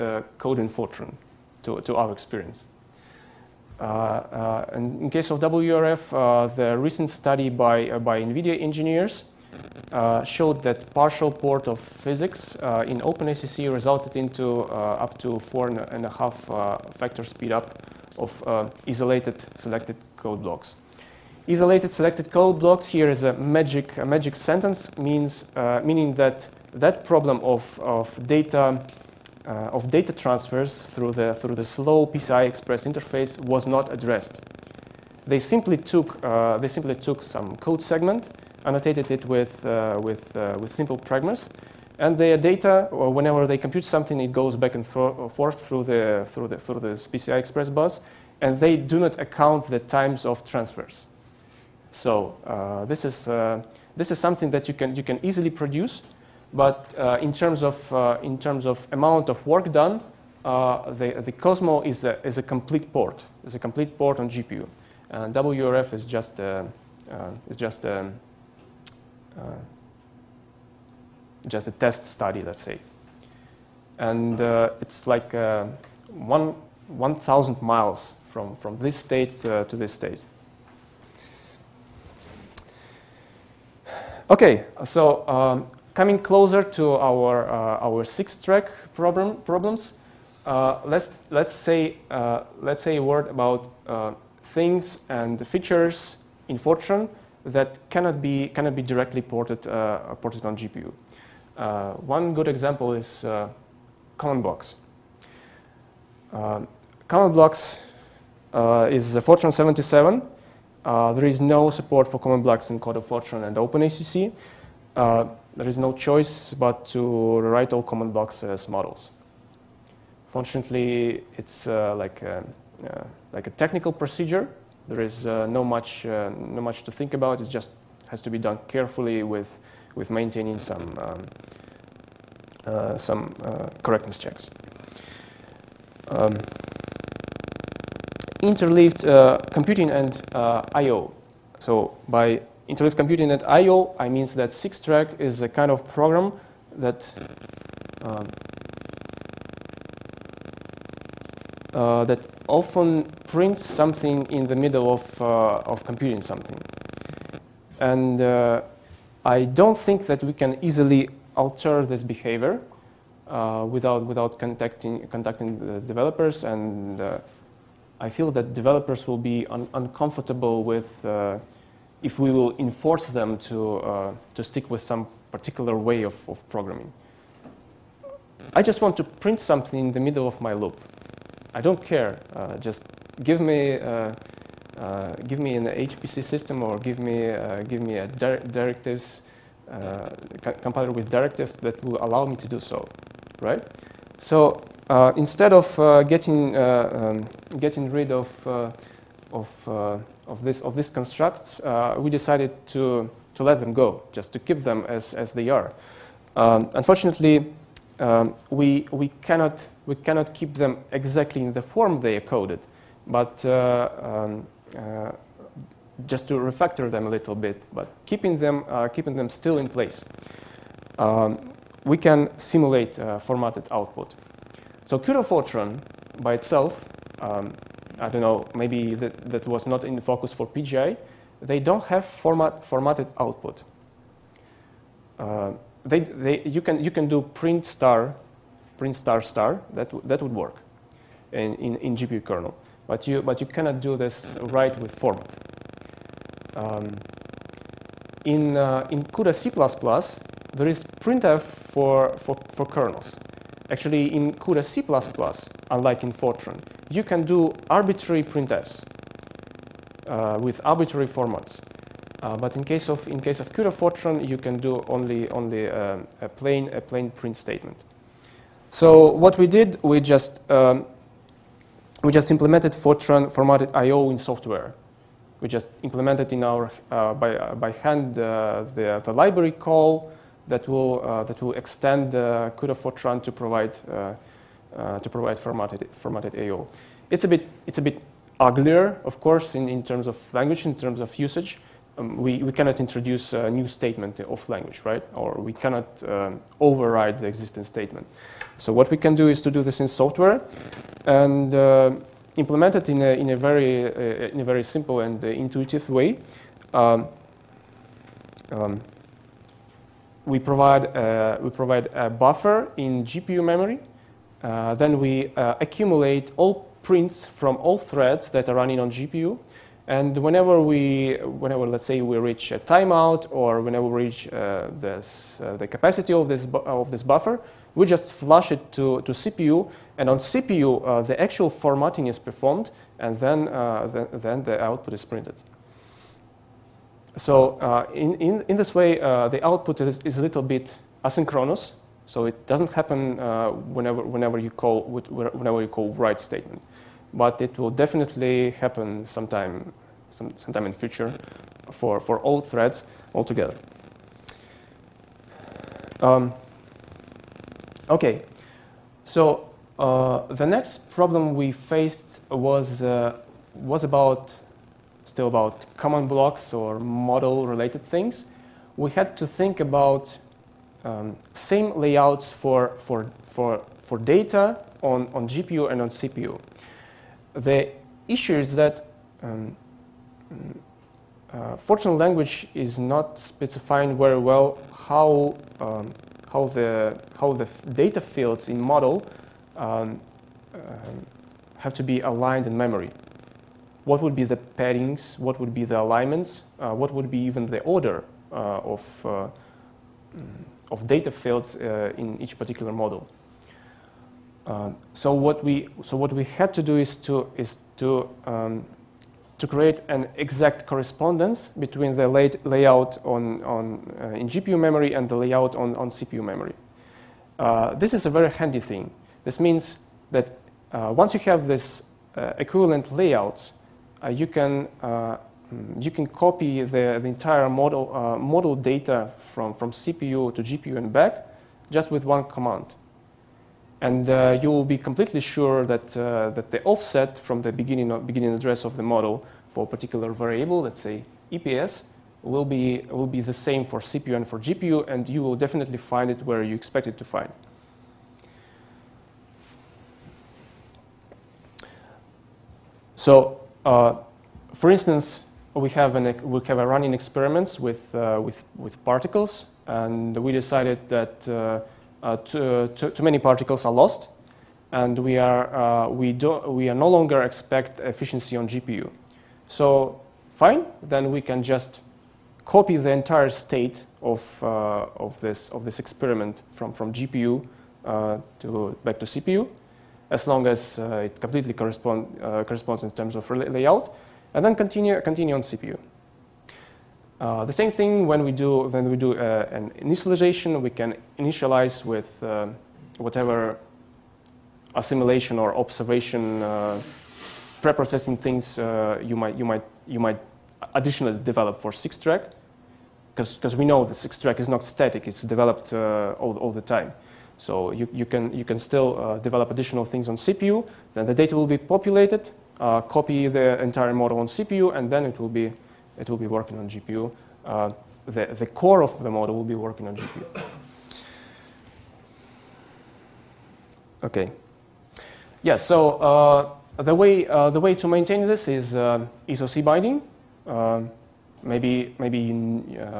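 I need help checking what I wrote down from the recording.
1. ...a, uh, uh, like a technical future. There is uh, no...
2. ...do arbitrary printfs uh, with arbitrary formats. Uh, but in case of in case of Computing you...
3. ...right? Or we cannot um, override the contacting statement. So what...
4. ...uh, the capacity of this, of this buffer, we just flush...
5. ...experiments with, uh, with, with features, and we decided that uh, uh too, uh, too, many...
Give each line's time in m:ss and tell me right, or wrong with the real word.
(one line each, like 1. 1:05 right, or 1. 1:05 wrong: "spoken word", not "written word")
1. 2:02 wrong: "procedure", not "future"
2. 4:17 wrong: "CUDA", not "Computing"
3. 4:54 wrong: "existing", not "contacting"
4. 5:25 right
5. 7:36 wrong: "particles", not "features".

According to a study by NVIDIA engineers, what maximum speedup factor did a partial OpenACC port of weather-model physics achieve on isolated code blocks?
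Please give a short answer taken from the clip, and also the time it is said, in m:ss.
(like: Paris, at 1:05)
4.5, at 0:15.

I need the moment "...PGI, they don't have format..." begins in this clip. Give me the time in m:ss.
3:50.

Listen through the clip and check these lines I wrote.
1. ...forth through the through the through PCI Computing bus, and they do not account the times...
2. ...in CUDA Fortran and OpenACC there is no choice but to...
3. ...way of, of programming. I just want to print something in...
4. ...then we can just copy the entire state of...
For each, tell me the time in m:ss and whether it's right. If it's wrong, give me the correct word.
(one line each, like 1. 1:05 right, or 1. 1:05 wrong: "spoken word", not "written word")
1. 0:44 wrong: "Express", not "Computing"
2. 1:52 right
3. 2:55 right
4. 7:50 right.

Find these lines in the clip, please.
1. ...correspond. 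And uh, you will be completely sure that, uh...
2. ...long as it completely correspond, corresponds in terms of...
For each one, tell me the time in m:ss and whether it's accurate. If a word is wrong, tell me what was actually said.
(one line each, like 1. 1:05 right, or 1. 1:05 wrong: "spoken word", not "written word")
1. 7:12 wrong: "command", not "correspond"
2. 8:00 right.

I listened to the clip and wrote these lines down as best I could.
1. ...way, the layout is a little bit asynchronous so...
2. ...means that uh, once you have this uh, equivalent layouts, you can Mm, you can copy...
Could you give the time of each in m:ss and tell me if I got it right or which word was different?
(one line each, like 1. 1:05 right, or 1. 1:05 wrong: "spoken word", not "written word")
1. 5:38 wrong: "output", not "layout"
2. 6:59 right.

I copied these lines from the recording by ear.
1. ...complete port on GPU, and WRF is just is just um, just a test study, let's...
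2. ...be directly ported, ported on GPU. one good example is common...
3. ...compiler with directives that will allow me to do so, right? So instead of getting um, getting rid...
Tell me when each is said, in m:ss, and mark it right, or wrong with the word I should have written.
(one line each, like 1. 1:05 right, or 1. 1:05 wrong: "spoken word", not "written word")
1. 1:03 right
2. 1:38 right
3. 3:10 right.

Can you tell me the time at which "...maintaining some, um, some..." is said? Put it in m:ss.
2:10.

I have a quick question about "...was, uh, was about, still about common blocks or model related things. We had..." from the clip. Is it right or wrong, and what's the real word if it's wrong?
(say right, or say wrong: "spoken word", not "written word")
right.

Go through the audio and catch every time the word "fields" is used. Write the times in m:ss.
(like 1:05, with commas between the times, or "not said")
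6:28, 6:41.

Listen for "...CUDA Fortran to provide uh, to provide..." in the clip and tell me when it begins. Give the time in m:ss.
4:42.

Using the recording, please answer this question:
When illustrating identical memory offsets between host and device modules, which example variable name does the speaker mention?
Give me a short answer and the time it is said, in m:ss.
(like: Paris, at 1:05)
EPS, at 7:21.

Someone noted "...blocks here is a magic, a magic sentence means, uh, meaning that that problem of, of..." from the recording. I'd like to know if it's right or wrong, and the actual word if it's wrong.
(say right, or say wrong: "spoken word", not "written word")
right.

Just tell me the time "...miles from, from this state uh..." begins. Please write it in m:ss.
1:17.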